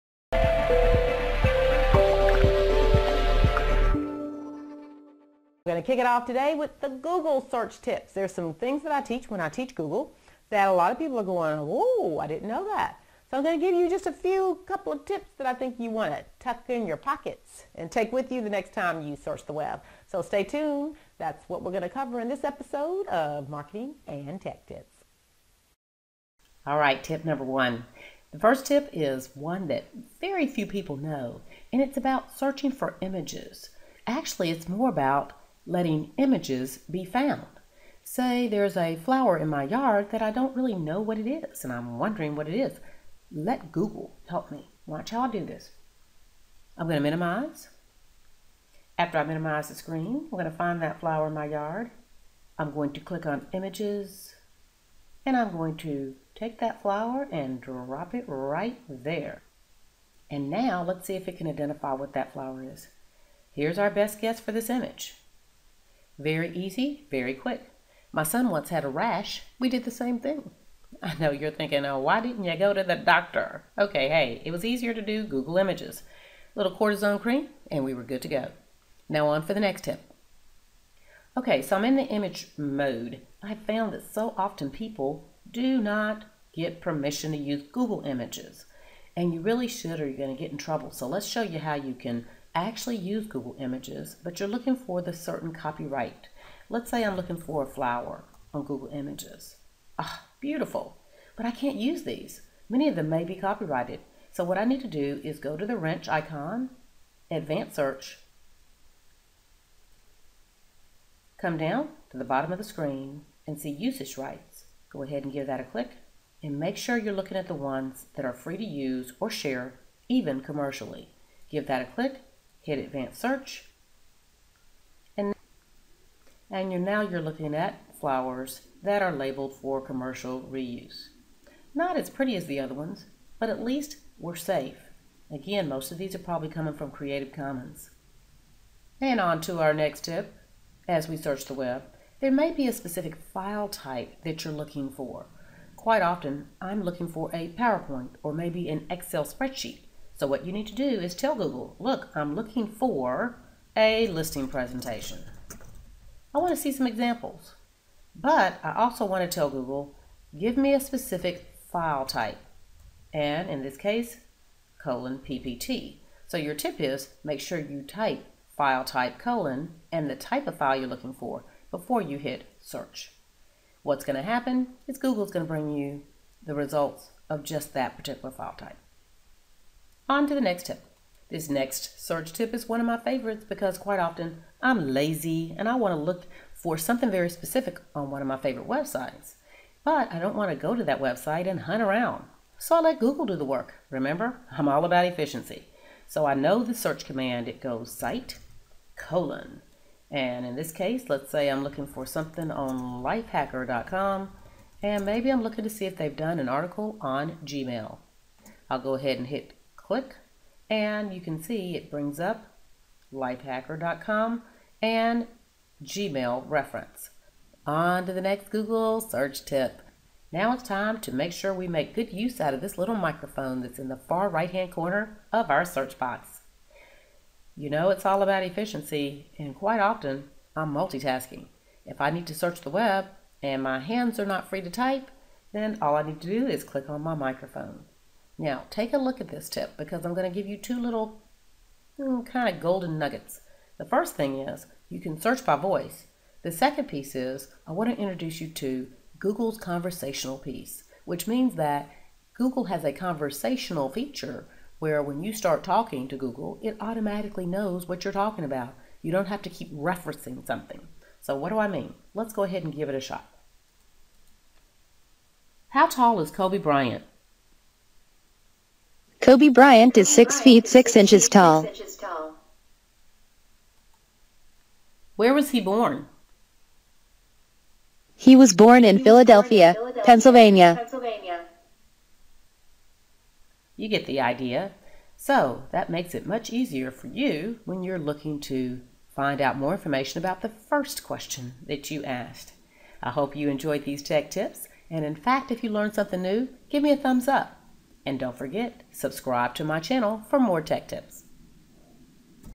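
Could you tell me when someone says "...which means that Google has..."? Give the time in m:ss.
4:11.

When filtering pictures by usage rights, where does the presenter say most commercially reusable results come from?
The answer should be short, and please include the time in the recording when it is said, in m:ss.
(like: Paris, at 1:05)
Creative Commons, at 2:16.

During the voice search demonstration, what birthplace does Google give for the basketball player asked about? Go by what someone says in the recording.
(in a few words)
Philadelphia, Pennsylvania.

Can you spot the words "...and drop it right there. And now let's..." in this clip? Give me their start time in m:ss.
0:57.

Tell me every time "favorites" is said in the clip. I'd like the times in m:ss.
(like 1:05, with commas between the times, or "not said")
3:02, 3:08.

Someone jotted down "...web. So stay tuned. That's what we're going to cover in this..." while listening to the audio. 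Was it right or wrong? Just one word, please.
right.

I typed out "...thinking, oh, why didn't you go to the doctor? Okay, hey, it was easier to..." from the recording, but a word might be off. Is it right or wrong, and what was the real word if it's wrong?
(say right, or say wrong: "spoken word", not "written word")
right.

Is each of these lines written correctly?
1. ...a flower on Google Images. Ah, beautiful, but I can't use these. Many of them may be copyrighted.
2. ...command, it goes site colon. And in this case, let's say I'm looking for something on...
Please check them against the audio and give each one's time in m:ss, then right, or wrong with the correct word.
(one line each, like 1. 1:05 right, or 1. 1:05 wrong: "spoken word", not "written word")
1. 1:37 right
2. 3:17 right.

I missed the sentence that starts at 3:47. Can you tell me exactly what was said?
You know it's all about efficiency and quite often I'm multitasking.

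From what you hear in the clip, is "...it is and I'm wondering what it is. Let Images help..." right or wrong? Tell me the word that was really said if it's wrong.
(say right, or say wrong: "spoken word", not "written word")
wrong: "Google", not "Images".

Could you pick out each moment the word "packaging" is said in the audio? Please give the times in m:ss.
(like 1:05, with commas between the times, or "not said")
not said.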